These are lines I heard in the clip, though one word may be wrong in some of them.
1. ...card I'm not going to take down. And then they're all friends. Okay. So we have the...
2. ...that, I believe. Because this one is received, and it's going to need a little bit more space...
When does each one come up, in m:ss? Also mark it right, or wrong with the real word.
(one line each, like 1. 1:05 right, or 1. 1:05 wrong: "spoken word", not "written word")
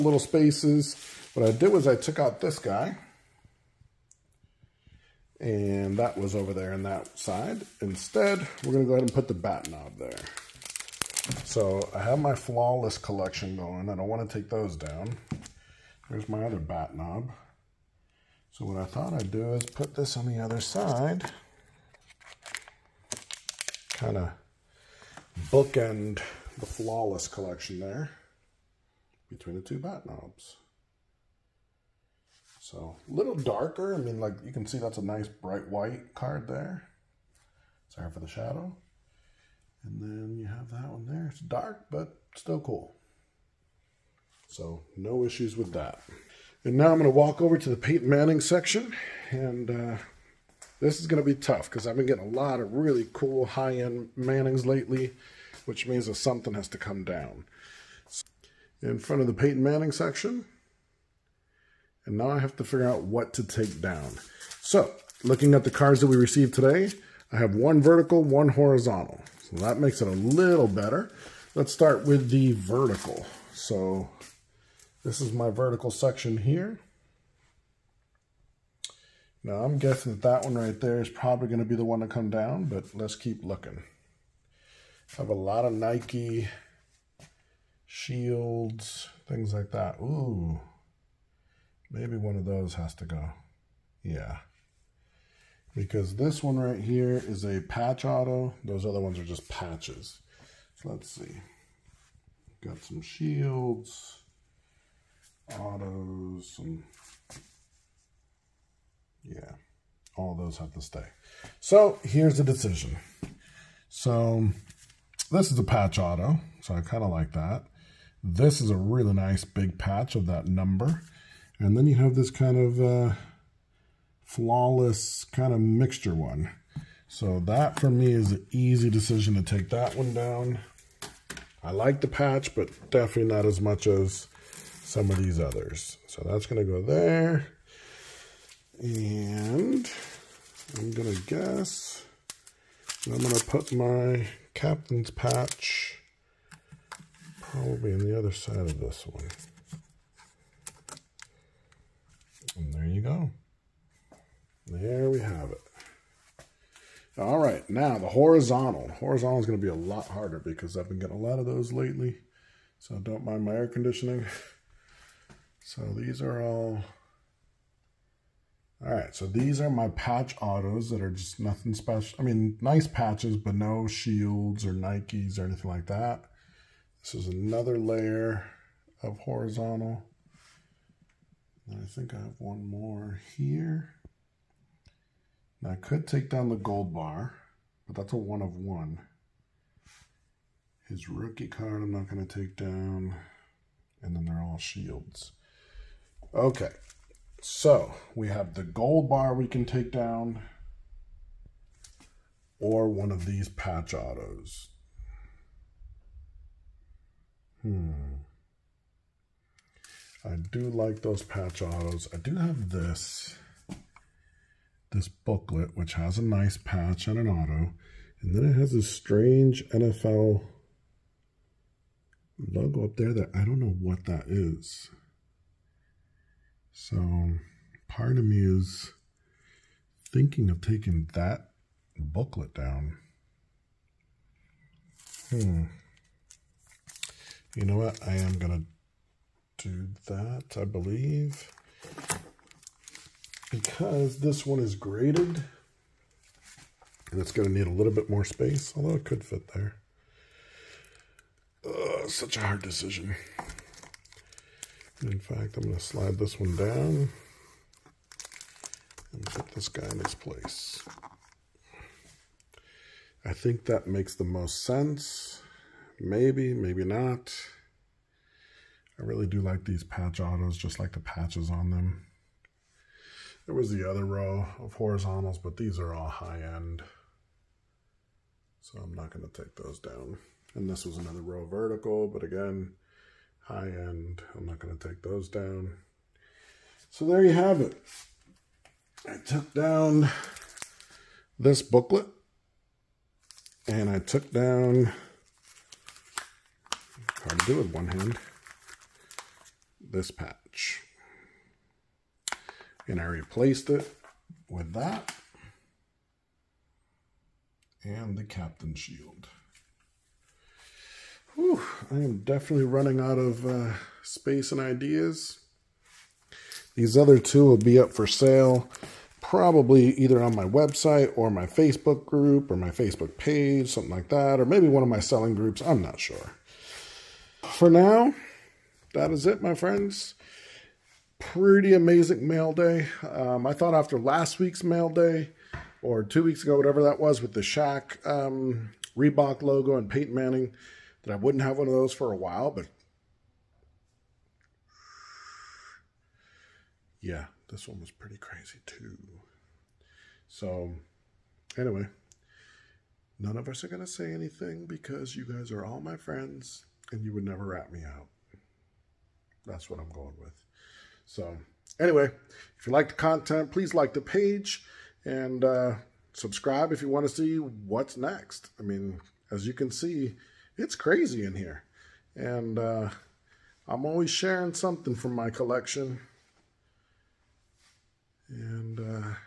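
1. 3:11 wrong: "shields", not "friends"
2. 4:00 wrong: "graded", not "received".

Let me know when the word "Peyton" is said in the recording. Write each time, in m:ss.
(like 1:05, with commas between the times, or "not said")
0:47, 0:59, 5:39.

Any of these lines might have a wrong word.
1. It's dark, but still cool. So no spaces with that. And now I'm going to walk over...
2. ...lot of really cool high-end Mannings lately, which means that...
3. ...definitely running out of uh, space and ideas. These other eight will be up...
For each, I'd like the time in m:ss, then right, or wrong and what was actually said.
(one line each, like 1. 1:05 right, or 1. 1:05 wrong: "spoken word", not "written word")
1. 0:41 wrong: "issues", not "spaces"
2. 0:52 right
3. 5:12 wrong: "two", not "eight".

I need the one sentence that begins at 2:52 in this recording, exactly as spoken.
I mean, nice patches, but no shields or Nikes or anything like that.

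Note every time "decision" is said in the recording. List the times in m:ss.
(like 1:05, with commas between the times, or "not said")
1:52, 2:08, 4:12.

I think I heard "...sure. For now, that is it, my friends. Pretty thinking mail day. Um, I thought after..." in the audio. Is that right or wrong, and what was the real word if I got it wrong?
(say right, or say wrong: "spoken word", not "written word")
wrong: "amazing", not "thinking".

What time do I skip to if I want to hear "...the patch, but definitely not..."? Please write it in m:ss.
2:12.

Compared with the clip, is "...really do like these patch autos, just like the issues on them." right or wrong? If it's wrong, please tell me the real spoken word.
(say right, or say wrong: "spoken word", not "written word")
wrong: "patches", not "issues".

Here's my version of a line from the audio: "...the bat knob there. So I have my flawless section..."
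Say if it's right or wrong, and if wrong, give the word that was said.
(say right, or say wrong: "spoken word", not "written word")
wrong: "collection", not "section".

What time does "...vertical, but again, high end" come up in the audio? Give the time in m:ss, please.
4:41.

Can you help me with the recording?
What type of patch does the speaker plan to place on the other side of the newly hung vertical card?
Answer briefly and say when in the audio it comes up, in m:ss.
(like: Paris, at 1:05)
Captain's patch, at 2:24.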